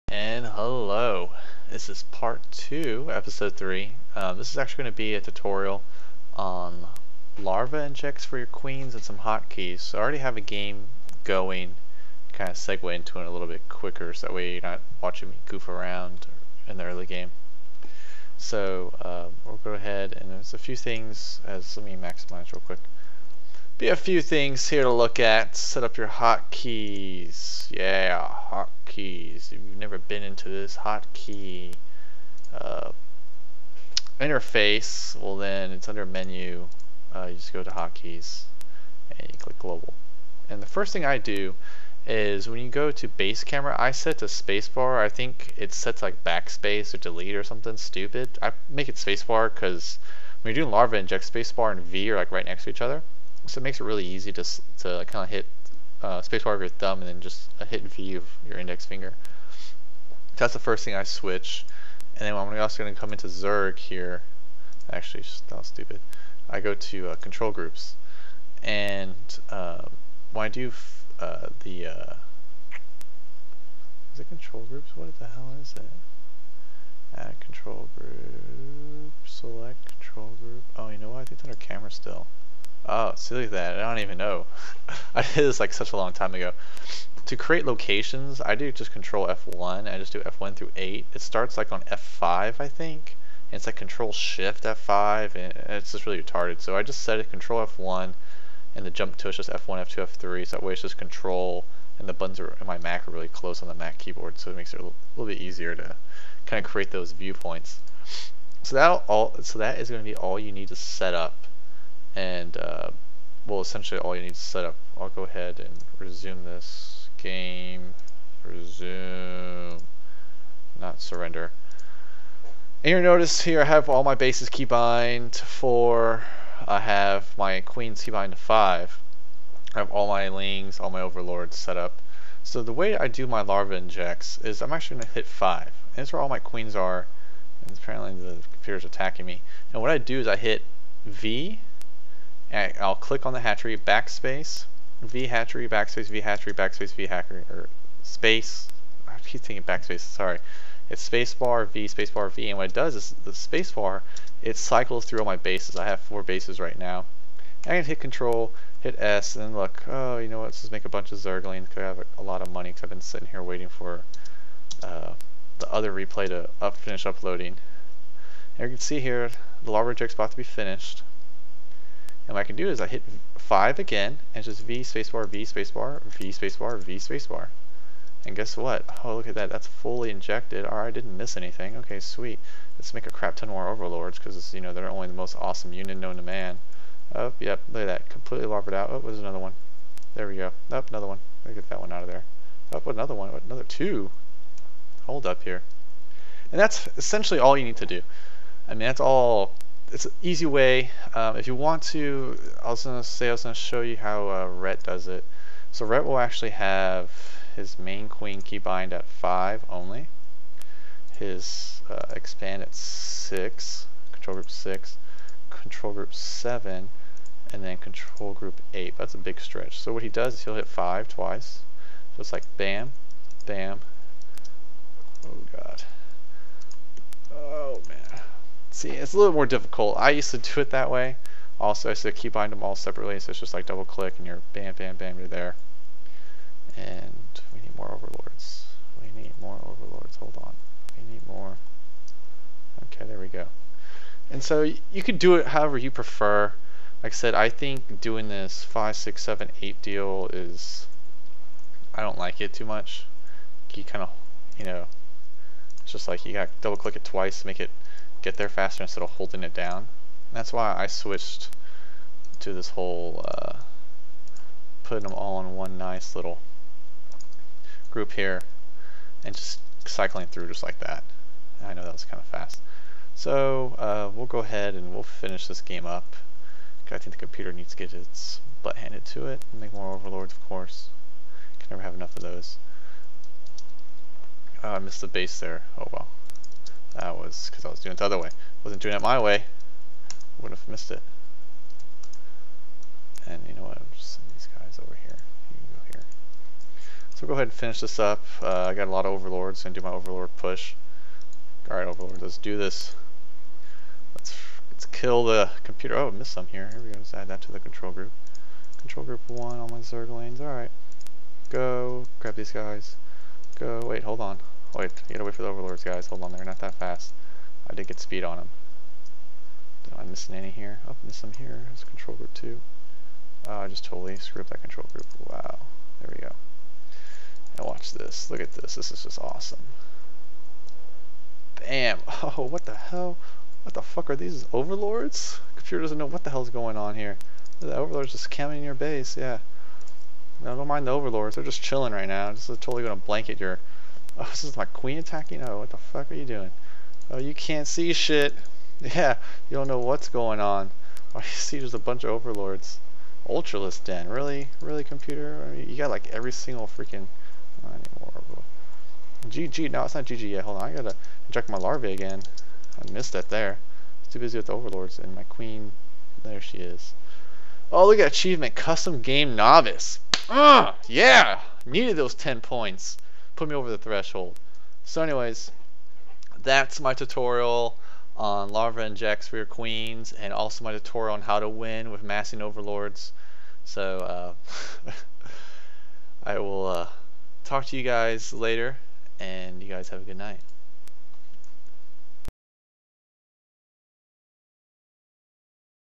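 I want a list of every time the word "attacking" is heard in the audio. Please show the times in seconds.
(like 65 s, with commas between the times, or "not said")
138 s, 344 s.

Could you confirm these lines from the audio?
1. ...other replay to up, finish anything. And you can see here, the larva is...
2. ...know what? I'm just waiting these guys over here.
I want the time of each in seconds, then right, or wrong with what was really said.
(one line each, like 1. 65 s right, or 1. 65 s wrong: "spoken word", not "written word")
1. 165 s wrong: "uploading", not "anything"
2. 293 s wrong: "sending", not "waiting".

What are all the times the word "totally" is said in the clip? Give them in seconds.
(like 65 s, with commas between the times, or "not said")
323 s, 342 s.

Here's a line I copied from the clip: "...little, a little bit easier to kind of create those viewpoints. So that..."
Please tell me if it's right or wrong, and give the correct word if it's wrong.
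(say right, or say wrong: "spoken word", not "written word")
right.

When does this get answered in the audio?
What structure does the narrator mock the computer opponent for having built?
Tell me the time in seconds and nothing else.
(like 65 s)
353 s.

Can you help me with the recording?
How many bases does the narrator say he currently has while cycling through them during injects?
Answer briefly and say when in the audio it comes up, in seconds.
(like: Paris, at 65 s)
4, at 155 s.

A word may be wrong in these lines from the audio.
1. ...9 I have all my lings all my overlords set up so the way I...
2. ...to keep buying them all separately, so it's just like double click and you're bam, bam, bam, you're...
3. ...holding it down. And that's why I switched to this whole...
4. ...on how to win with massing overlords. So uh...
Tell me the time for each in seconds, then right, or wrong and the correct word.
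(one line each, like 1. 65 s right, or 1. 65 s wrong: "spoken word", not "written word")
1. 128 s wrong: "5", not "9"
2. 232 s right
3. 259 s right
4. 381 s right.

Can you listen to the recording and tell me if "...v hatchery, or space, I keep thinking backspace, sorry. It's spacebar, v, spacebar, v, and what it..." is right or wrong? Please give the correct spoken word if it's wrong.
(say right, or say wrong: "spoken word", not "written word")
right.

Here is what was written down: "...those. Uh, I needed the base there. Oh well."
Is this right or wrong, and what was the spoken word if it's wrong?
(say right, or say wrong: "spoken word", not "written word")
wrong: "missed", not "needed".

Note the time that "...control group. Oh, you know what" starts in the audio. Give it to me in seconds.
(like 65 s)
79 s.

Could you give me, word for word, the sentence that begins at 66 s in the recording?
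I go to uh, control groups.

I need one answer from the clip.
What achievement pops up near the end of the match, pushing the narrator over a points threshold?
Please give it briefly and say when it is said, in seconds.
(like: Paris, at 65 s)
Custom game novice, at 368 s.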